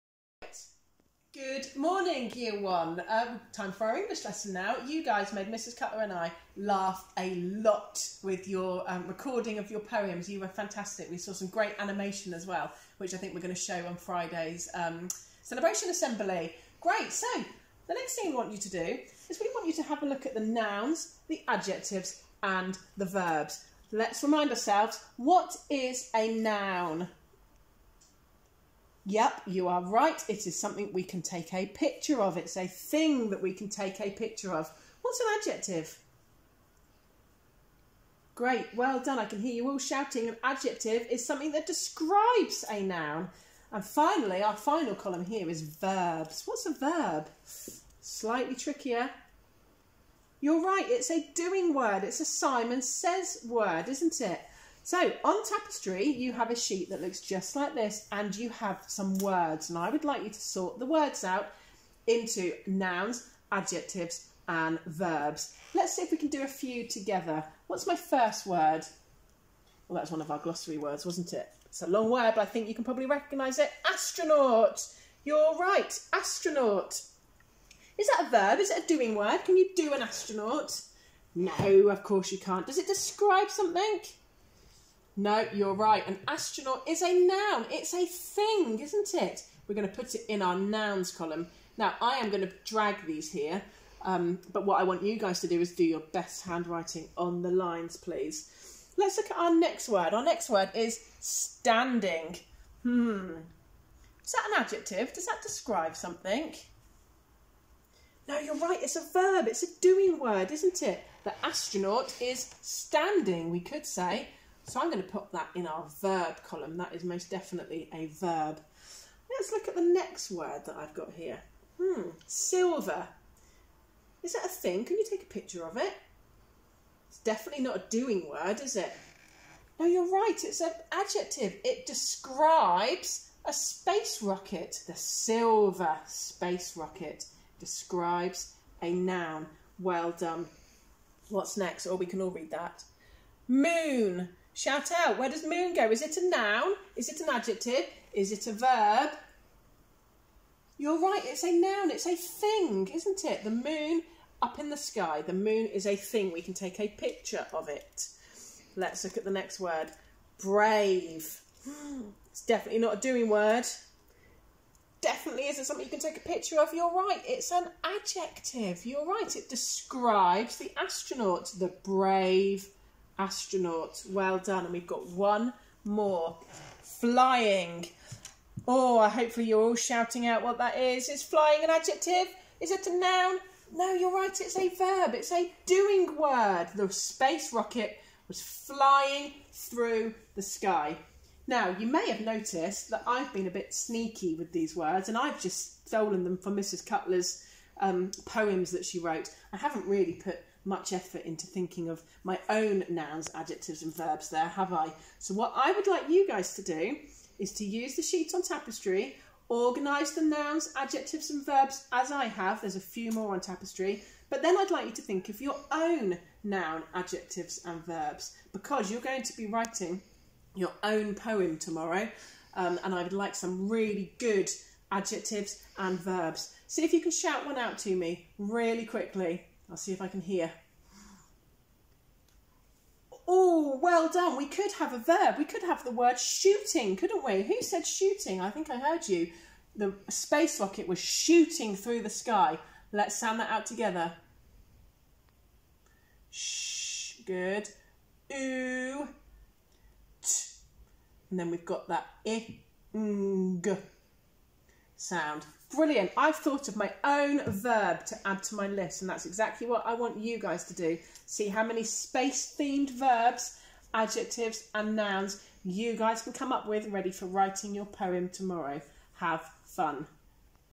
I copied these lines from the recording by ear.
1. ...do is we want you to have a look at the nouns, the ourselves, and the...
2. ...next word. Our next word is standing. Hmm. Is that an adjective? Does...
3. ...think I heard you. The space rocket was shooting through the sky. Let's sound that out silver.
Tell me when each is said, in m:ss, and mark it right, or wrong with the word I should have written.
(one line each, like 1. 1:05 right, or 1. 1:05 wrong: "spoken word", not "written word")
1. 0:18 wrong: "adjectives", not "ourselves"
2. 1:39 right
3. 3:58 wrong: "together", not "silver".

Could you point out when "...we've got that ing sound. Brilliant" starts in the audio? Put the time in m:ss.
4:11.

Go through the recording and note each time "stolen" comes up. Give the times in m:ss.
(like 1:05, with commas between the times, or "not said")
3:15.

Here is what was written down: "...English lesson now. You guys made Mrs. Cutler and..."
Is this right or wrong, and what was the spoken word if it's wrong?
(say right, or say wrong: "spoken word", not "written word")
right.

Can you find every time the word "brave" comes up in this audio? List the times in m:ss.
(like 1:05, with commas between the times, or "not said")
2:40, 2:51.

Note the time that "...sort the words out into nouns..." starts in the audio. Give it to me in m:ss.
1:00.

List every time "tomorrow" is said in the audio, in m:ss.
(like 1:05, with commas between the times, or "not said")
3:41, 4:28.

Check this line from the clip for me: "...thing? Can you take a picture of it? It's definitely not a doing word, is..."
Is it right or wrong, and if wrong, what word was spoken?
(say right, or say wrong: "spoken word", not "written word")
right.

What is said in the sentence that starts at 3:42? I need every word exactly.
Um, and I would like some really good adjectives and verbs.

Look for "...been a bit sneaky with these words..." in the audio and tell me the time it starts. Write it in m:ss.
3:13.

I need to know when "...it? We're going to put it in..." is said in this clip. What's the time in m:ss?
1:29.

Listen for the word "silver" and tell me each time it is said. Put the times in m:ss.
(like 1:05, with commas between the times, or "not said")
2:02, 2:14.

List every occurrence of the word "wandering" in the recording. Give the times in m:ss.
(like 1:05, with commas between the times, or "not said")
not said.